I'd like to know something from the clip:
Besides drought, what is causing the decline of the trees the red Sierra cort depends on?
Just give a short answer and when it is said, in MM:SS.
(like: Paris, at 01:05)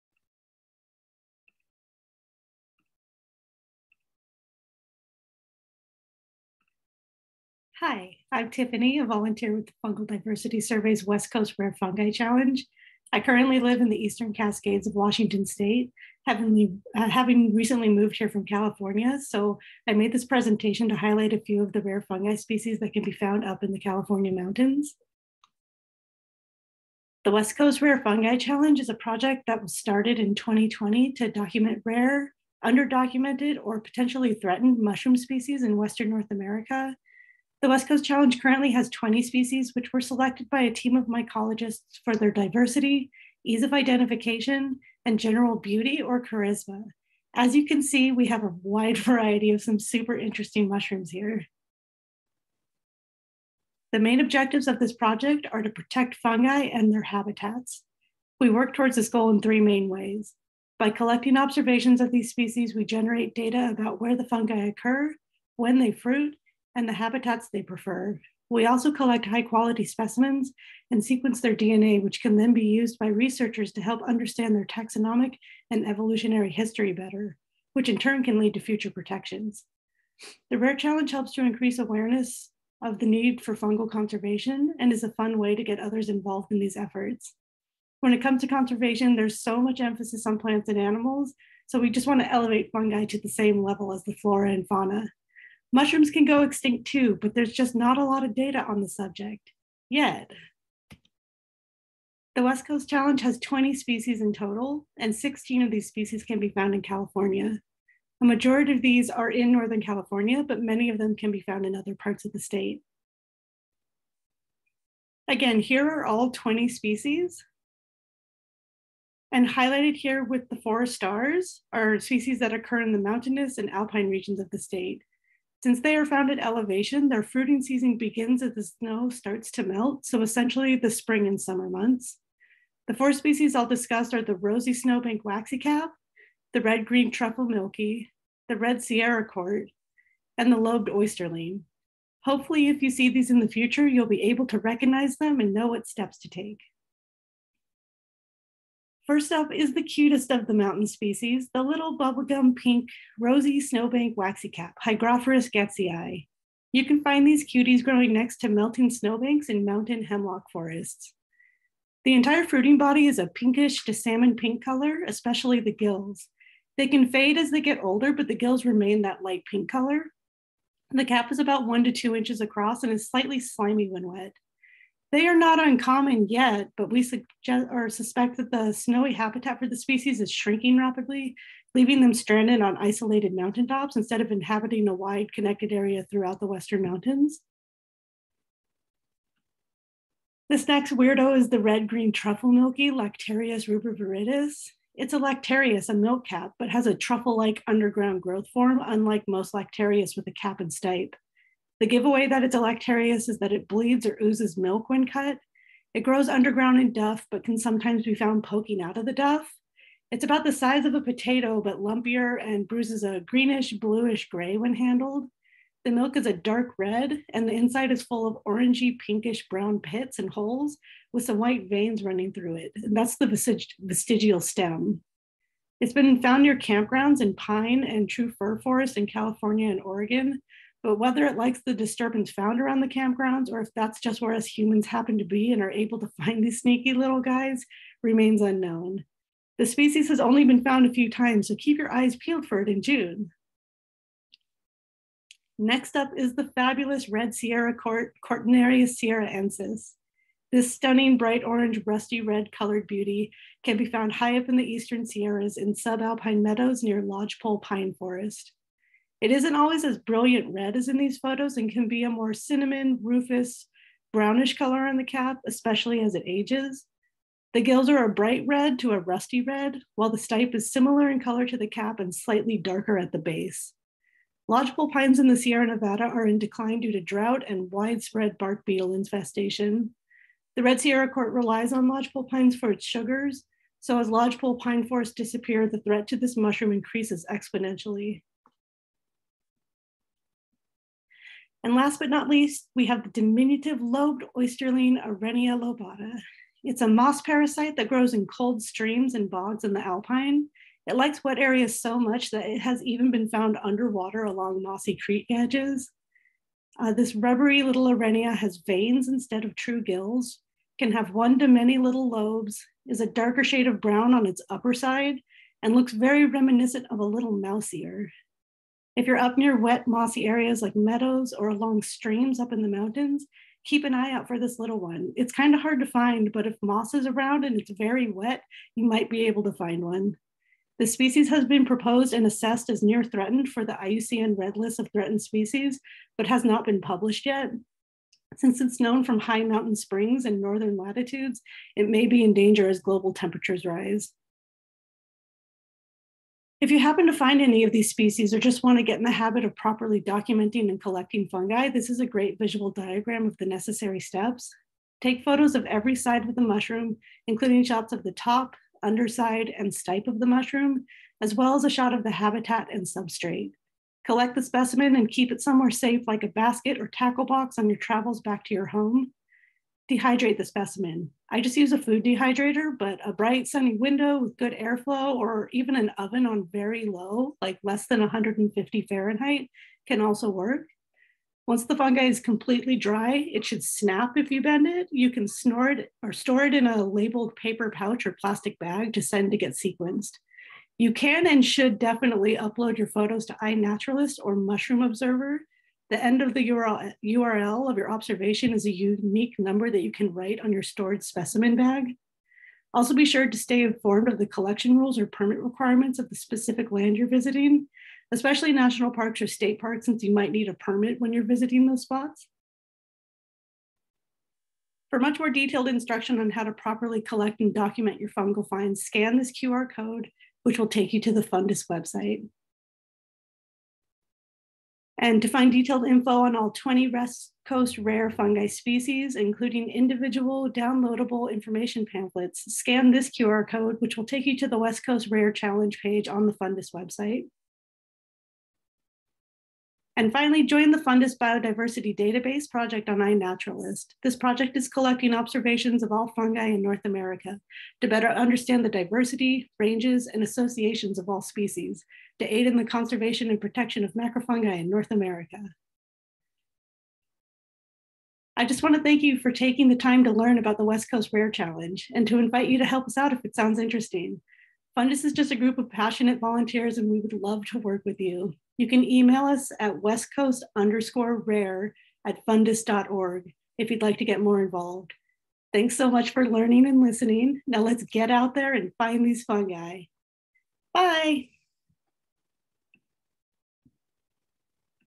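Bark beetle infestation, at 04:38.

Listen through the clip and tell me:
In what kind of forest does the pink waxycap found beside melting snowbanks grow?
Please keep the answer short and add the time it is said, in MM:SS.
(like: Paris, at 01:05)
Mountain hemlock forests, at 02:39.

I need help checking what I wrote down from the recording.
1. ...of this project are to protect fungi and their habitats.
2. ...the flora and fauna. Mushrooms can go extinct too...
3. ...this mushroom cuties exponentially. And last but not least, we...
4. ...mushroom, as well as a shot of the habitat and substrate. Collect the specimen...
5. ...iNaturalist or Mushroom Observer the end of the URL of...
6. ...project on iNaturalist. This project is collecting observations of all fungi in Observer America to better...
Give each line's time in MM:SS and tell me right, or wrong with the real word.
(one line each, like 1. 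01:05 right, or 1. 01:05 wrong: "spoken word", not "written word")
1. 00:54 right
2. 01:34 right
3. 04:46 wrong: "increases", not "cuties"
4. 06:00 right
5. 06:33 right
6. 07:22 wrong: "North", not "Observer".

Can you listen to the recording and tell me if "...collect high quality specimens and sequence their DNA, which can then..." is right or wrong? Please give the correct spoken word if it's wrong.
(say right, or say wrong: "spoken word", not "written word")
right.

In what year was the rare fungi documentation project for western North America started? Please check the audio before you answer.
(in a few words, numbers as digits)
2020.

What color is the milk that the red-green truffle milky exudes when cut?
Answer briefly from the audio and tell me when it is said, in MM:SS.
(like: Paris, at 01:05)
Dark red, at 03:36.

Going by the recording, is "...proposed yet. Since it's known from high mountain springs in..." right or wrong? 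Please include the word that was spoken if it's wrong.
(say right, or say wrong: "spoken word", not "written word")
wrong: "published", not "proposed".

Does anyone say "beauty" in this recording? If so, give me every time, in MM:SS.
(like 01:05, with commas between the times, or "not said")
00:45, 04:12.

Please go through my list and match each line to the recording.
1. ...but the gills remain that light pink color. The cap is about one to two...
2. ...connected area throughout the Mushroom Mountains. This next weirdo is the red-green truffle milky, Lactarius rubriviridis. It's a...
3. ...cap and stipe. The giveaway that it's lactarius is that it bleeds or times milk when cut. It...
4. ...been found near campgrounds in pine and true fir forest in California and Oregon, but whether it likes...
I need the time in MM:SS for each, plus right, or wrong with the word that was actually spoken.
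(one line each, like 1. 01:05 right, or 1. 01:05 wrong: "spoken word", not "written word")
1. 02:48 right
2. 03:05 wrong: "Western", not "Mushroom"
3. 03:20 wrong: "oozes", not "times"
4. 03:45 right.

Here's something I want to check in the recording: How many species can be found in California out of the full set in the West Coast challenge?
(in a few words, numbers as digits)
16.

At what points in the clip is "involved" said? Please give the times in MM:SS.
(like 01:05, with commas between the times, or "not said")
01:26, 07:54.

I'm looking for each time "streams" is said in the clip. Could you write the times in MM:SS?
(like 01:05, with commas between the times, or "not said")
04:58, 05:21.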